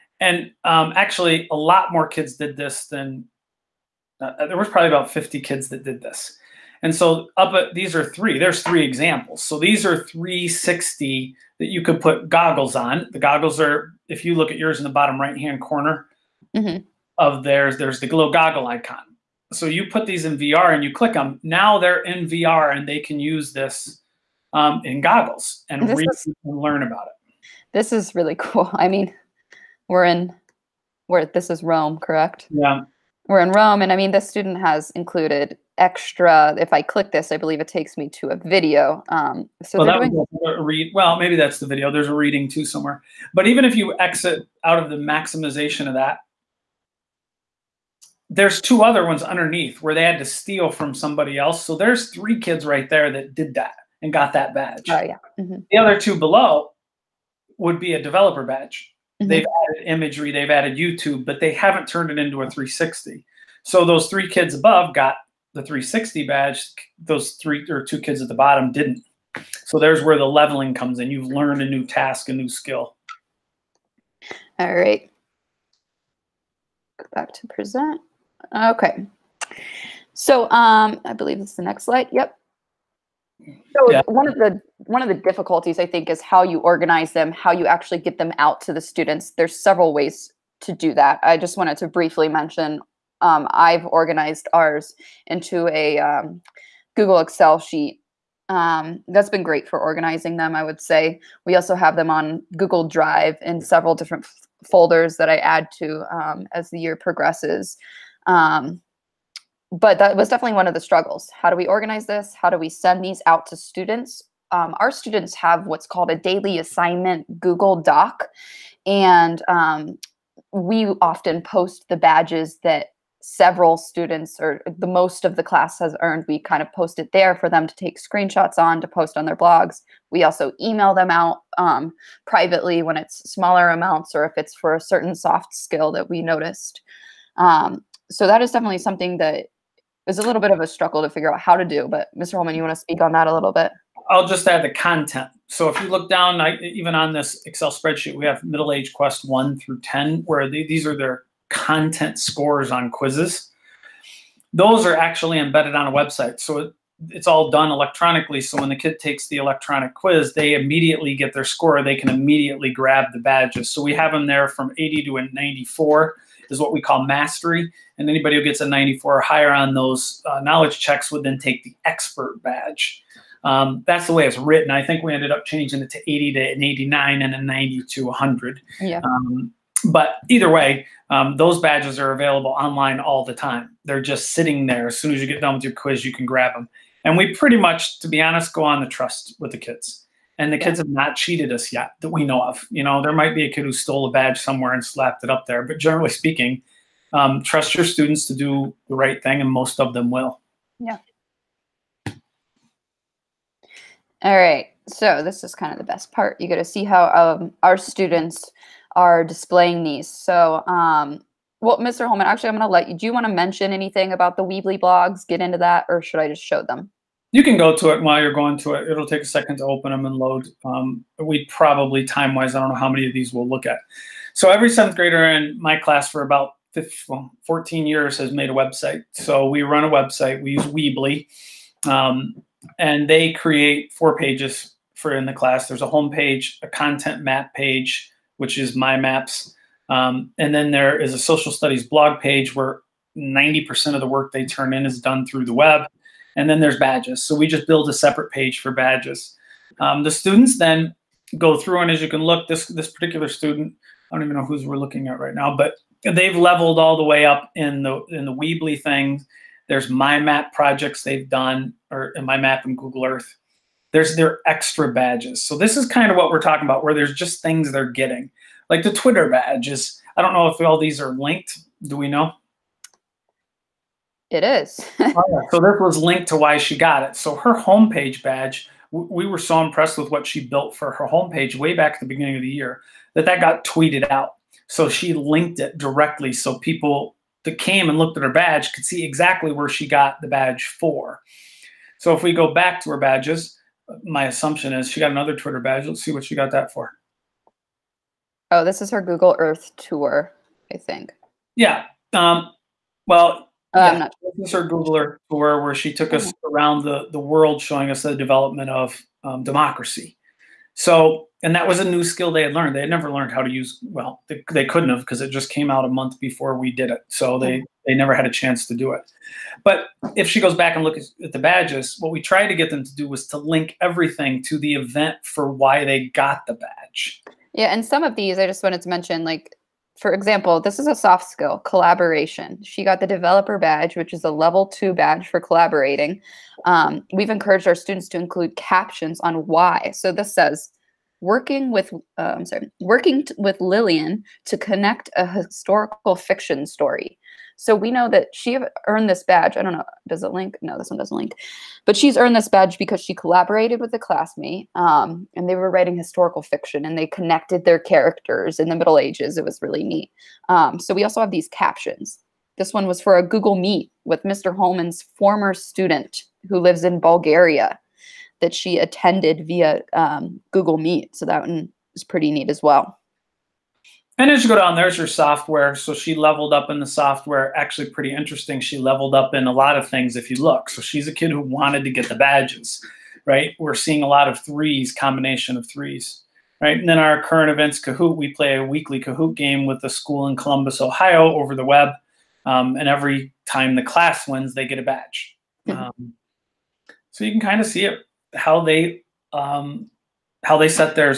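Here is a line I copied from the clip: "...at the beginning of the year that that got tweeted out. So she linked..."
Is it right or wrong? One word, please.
right.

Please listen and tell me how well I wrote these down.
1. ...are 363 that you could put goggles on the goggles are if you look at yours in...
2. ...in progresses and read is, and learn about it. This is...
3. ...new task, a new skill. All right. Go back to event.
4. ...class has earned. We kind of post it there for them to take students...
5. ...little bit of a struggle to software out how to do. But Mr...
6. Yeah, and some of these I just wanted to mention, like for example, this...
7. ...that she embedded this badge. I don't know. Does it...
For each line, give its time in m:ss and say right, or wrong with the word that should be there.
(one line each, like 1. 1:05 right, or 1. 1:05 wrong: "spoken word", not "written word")
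1. 0:09 wrong: "360", not "363"
2. 0:24 wrong: "goggles", not "progresses"
3. 1:11 wrong: "present", not "event"
4. 2:05 wrong: "screenshots", not "students"
5. 2:20 wrong: "figure", not "software"
6. 5:27 right
7. 5:48 wrong: "earned", not "embedded".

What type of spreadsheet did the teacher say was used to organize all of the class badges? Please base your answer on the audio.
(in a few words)
Google Excel sheet.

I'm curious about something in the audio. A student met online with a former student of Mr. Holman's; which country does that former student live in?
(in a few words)
Bulgaria.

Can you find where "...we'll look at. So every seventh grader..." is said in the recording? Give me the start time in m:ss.
3:43.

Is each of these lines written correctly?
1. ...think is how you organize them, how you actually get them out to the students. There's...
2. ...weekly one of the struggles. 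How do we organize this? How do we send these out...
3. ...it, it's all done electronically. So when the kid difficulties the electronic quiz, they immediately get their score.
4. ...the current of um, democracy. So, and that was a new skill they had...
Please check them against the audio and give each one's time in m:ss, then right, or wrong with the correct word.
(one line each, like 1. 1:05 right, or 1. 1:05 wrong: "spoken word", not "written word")
1. 1:25 right
2. 1:50 wrong: "definitely", not "weekly"
3. 2:36 wrong: "takes", not "difficulties"
4. 5:08 wrong: "development", not "current".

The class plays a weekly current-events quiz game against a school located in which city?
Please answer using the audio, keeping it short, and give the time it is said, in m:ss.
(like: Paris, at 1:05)
Columbus, Ohio, at 6:30.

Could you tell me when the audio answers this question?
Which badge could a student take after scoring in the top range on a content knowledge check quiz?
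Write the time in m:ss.
2:51.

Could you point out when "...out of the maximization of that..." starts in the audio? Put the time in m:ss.
0:44.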